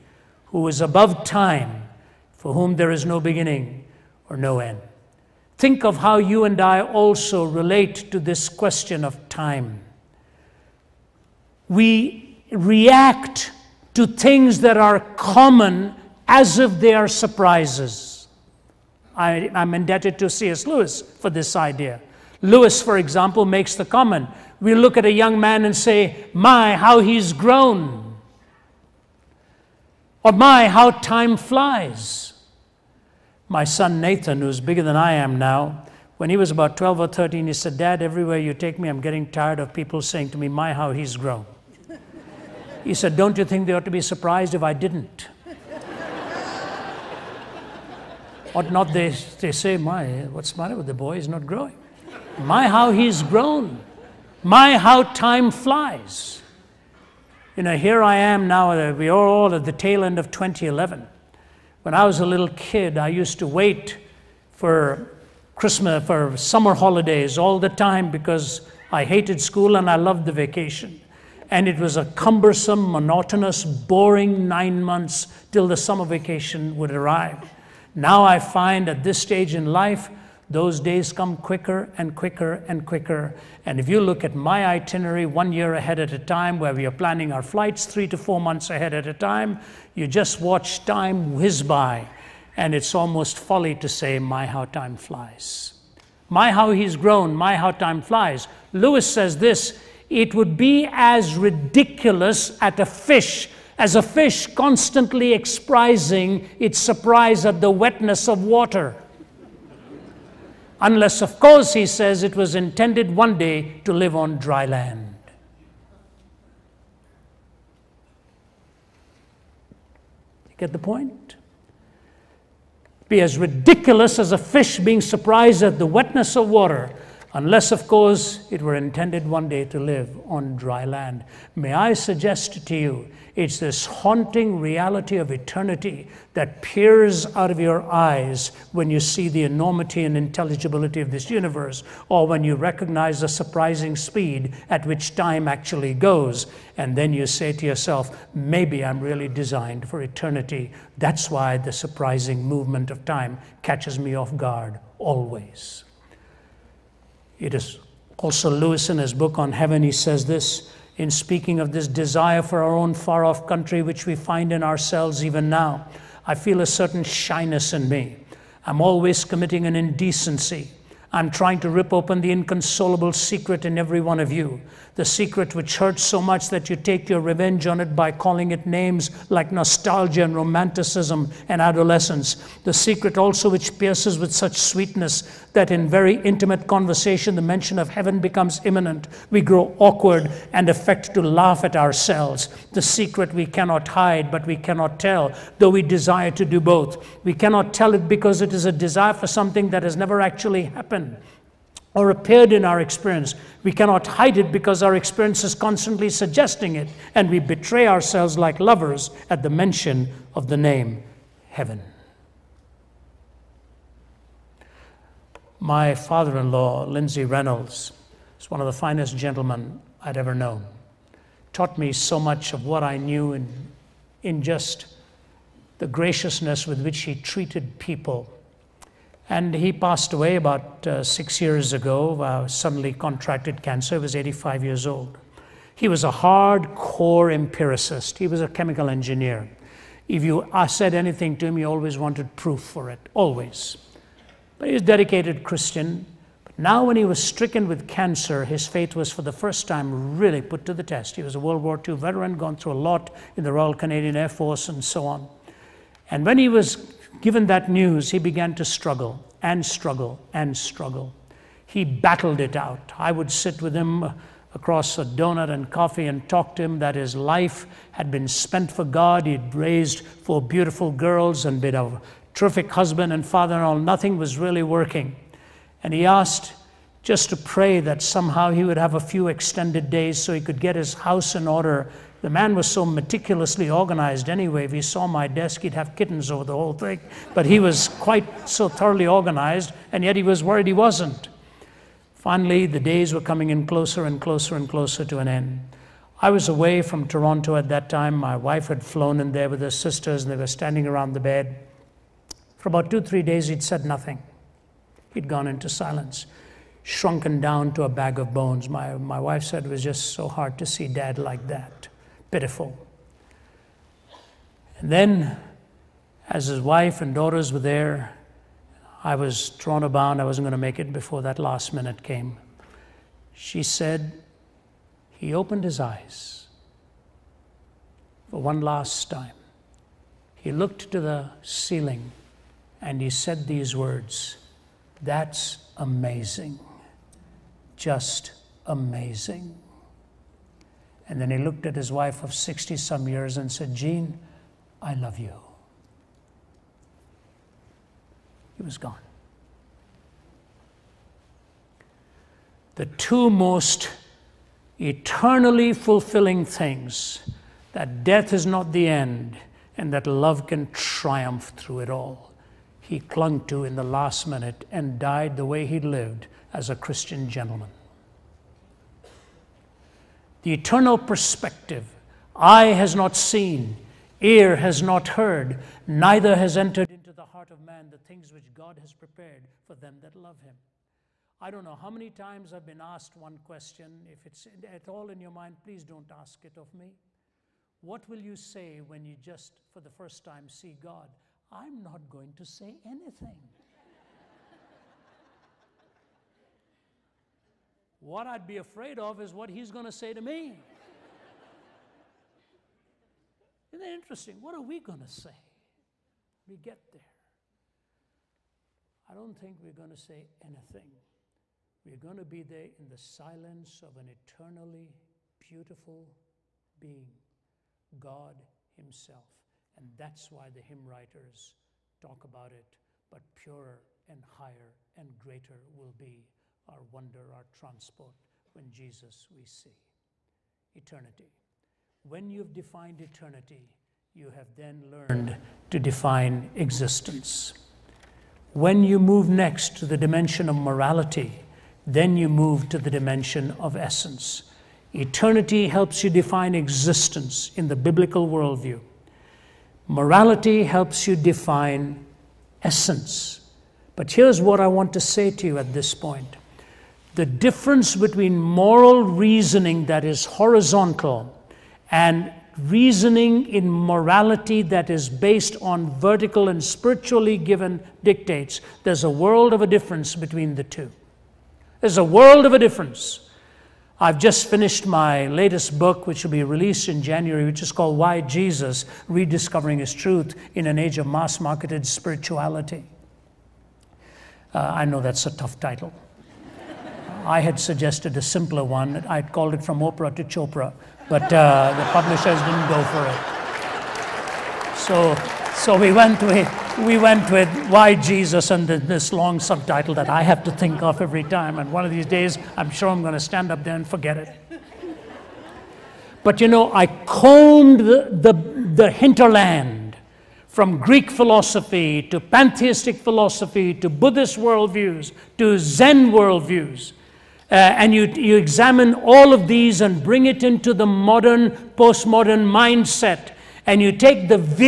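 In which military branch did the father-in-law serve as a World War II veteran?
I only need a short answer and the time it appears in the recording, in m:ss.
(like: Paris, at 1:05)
Royal Canadian Air Force, at 4:13.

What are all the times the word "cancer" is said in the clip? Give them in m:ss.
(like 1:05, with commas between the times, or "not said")
3:53, 4:07.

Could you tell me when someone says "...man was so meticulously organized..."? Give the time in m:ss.
4:42.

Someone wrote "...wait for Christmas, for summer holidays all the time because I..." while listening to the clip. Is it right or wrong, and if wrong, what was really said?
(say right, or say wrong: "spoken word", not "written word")
right.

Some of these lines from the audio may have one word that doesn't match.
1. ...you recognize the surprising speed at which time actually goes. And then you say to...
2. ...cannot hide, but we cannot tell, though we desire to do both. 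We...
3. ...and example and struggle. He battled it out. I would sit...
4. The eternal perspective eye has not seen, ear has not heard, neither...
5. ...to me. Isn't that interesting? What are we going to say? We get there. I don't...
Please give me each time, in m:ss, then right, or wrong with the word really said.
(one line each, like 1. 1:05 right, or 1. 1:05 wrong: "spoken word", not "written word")
1. 2:22 right
2. 3:13 right
3. 4:19 wrong: "struggle", not "example"
4. 6:10 right
5. 6:40 right.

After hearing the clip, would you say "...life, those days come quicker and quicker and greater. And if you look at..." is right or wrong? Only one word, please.
wrong.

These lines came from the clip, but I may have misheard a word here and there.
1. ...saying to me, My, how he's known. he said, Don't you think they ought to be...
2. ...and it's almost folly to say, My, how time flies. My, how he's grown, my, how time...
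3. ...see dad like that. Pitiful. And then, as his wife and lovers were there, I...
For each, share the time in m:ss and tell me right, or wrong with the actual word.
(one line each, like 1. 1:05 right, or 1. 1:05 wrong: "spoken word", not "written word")
1. 0:40 wrong: "grown", not "known"
2. 1:32 right
3. 5:10 wrong: "daughters", not "lovers".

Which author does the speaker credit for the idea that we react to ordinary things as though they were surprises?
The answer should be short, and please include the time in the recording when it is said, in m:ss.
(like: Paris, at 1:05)
C.S. Lewis, at 0:20.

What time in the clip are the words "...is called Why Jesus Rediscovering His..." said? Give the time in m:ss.
7:57.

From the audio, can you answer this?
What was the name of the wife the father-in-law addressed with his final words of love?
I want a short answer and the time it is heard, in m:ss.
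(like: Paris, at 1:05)
Jean, at 5:43.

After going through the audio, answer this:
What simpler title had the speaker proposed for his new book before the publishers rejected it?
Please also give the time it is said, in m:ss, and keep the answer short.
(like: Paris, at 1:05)
From Oprah to Chopra, at 8:09.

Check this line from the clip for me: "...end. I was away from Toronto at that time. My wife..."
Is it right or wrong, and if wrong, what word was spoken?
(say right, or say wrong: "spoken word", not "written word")
right.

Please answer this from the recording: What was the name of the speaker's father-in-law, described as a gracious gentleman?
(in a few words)
Lindsay Reynolds.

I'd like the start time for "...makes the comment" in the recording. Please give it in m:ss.
0:23.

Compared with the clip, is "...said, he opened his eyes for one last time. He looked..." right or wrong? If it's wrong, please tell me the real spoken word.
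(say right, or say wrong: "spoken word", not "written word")
right.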